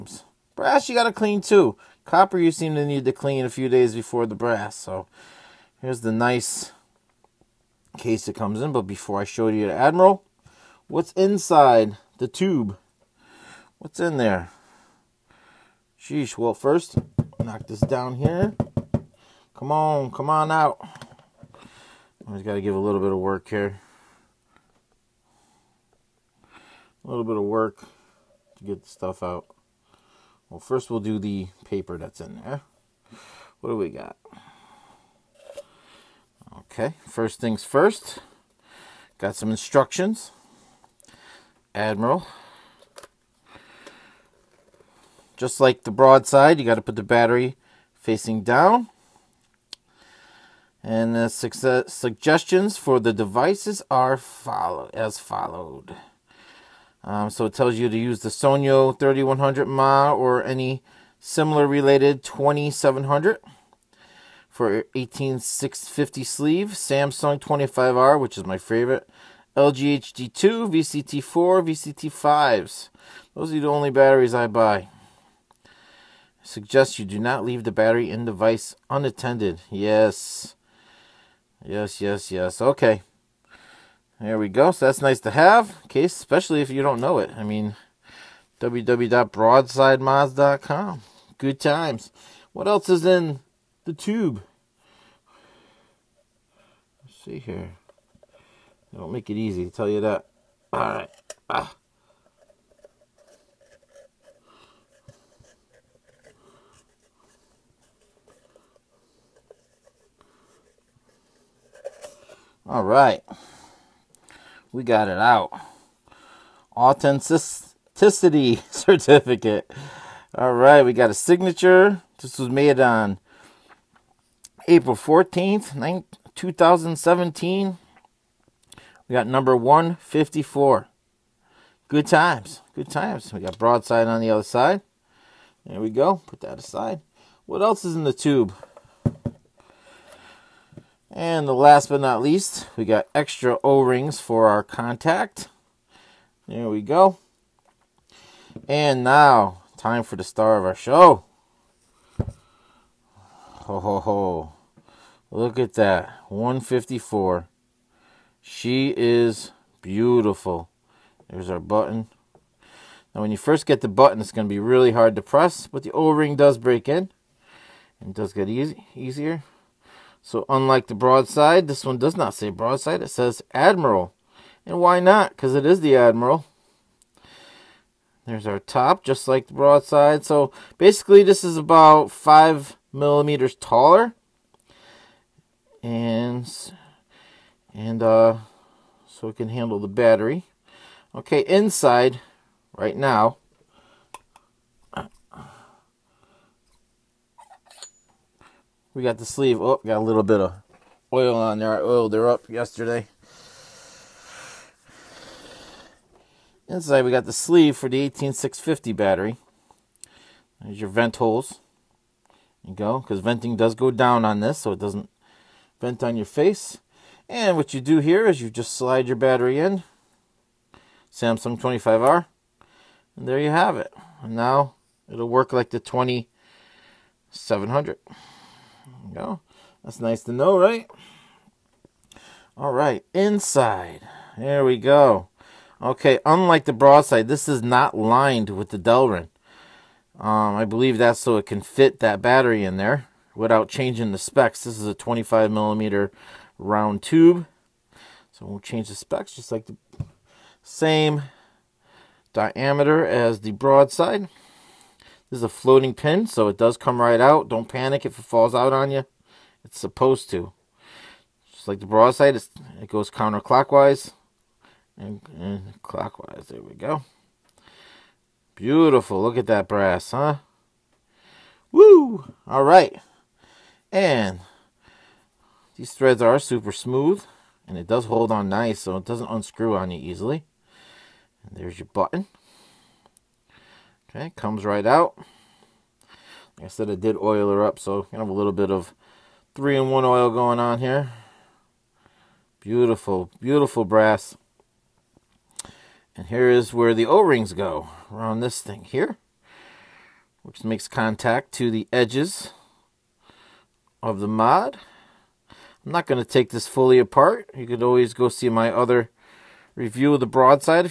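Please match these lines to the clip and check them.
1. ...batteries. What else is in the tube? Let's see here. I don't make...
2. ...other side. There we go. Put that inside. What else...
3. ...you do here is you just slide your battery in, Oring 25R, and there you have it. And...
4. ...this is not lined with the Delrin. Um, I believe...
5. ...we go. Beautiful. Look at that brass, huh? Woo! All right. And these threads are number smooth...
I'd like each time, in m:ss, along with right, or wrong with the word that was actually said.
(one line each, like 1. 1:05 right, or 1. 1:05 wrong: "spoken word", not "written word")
1. 1:31 wrong: "times", not "batteries"
2. 2:14 wrong: "aside", not "inside"
3. 3:37 wrong: "Samsung", not "Oring"
4. 3:57 right
5. 4:26 wrong: "super", not "number".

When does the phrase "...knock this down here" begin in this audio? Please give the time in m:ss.
0:17.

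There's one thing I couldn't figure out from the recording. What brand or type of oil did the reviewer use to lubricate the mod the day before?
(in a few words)
3-in-1 oil.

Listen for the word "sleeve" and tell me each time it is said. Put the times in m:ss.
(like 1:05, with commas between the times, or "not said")
1:06, 3:19, 3:27.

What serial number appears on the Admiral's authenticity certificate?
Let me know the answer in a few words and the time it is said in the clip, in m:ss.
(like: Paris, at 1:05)
154, at 2:09.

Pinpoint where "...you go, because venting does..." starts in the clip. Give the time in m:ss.
3:32.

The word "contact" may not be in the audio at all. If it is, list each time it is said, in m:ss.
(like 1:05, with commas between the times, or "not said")
2:24, 5:00.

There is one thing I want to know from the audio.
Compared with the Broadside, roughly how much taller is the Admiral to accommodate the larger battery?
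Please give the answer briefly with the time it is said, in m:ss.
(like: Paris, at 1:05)
5 millimeters, at 3:02.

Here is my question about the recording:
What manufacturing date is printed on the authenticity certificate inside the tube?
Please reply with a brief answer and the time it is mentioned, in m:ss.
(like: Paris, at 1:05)
April 14, 2017, at 2:04.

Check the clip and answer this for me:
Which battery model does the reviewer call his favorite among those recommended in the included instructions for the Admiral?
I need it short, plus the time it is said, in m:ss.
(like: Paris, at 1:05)
Samsung 25R, at 1:06.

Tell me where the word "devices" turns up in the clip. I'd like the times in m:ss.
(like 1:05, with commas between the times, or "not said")
0:53.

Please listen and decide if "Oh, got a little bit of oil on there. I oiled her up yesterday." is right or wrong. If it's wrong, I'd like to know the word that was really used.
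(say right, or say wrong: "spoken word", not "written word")
right.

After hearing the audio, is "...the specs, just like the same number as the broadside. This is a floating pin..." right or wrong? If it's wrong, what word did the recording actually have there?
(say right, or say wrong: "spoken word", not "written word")
wrong: "diameter", not "number".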